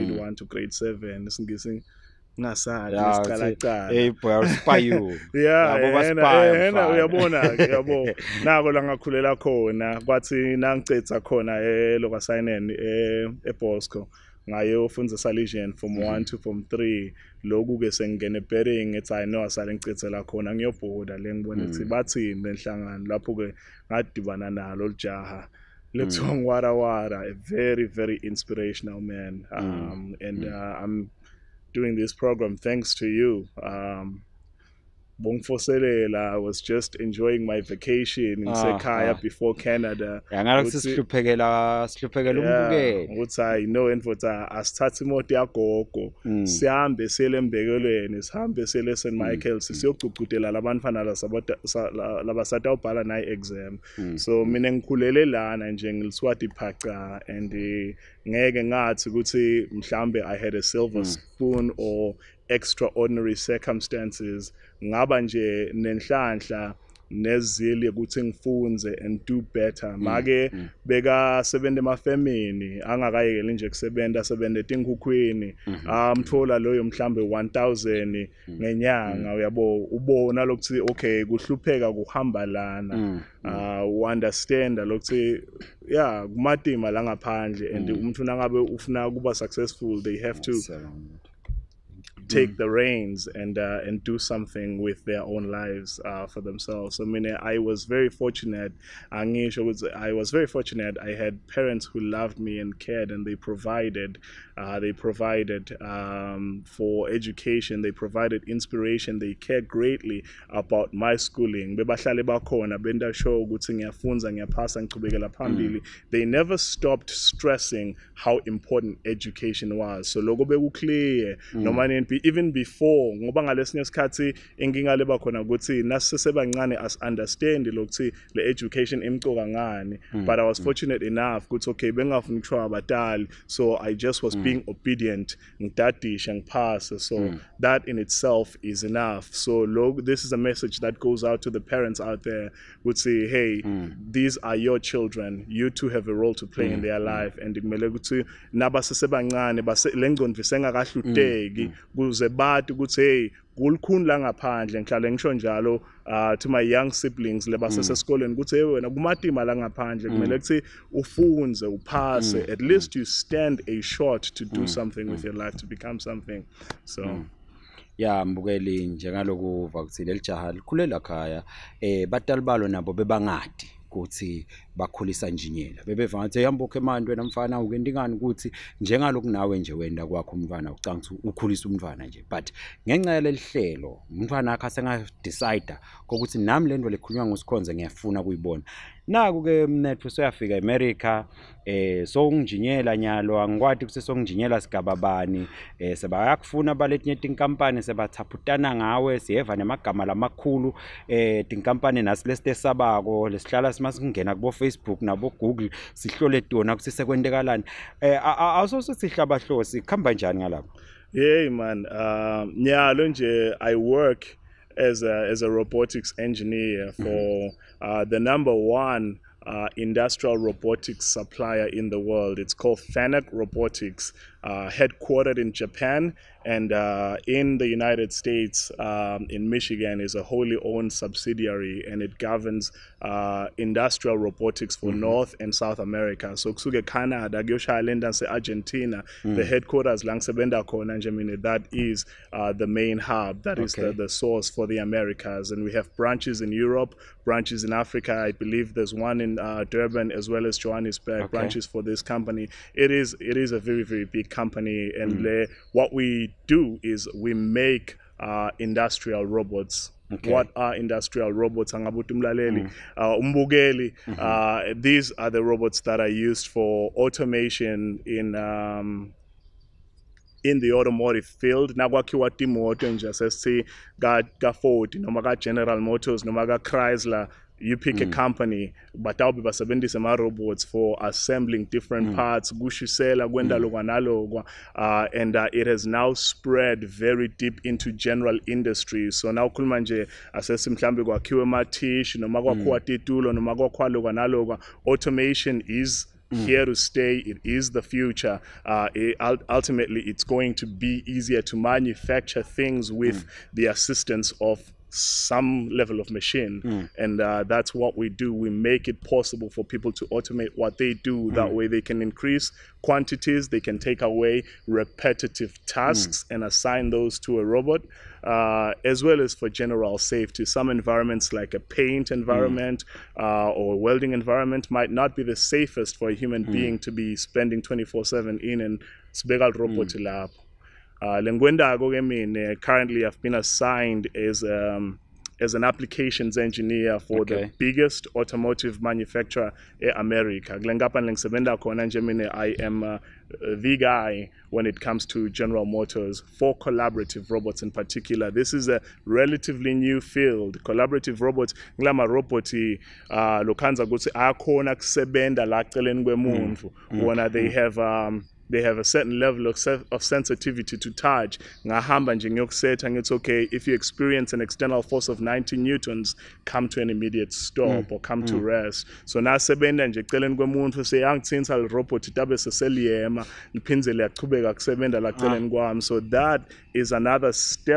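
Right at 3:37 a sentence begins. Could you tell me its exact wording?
uh, the number one uh, industrial robotics supplier in the world.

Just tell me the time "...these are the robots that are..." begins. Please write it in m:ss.
4:24.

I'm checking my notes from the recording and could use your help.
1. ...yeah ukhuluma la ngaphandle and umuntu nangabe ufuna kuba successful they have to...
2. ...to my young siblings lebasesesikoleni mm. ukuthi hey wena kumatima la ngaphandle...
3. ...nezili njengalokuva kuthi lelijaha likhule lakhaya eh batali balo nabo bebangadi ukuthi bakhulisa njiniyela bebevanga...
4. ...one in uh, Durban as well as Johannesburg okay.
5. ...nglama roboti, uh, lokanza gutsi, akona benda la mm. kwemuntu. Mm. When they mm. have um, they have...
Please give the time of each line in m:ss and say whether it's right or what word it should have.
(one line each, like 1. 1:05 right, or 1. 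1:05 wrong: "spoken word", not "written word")
1. 1:25 wrong: "kumatima", not "ukhuluma"
2. 2:36 right
3. 2:48 wrong: "mbukeli", not "nezili"
4. 4:08 right
5. 5:51 wrong: "kusebenda", not "benda".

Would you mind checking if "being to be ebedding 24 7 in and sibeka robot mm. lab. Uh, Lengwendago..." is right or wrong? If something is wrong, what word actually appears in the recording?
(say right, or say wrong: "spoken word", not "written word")
wrong: "spending", not "ebedding".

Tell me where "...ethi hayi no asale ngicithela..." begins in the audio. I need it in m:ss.
0:18.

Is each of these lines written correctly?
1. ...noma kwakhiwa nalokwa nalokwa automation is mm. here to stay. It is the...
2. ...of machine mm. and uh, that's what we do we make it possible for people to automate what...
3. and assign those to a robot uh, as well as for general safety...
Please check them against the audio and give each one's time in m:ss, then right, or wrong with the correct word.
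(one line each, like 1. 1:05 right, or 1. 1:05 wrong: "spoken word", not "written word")
1. 4:53 wrong: "lokwa", not "nalokwa"
2. 5:06 right
3. 5:16 right.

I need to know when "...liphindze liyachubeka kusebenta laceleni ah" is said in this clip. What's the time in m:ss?
6:13.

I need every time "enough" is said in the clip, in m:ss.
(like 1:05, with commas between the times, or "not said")
2:11, 2:18.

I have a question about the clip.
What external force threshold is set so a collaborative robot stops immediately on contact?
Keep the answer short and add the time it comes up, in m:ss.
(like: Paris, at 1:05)
90 newtons, at 6:05.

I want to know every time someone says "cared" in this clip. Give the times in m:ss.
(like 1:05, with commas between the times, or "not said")
1:42, 1:49.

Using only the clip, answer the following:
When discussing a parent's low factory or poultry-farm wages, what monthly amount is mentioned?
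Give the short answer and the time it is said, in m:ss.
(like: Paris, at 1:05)
1000, at 1:17.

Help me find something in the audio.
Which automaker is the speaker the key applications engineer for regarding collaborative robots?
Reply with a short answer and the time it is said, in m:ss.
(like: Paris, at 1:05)
General Motors, at 5:45.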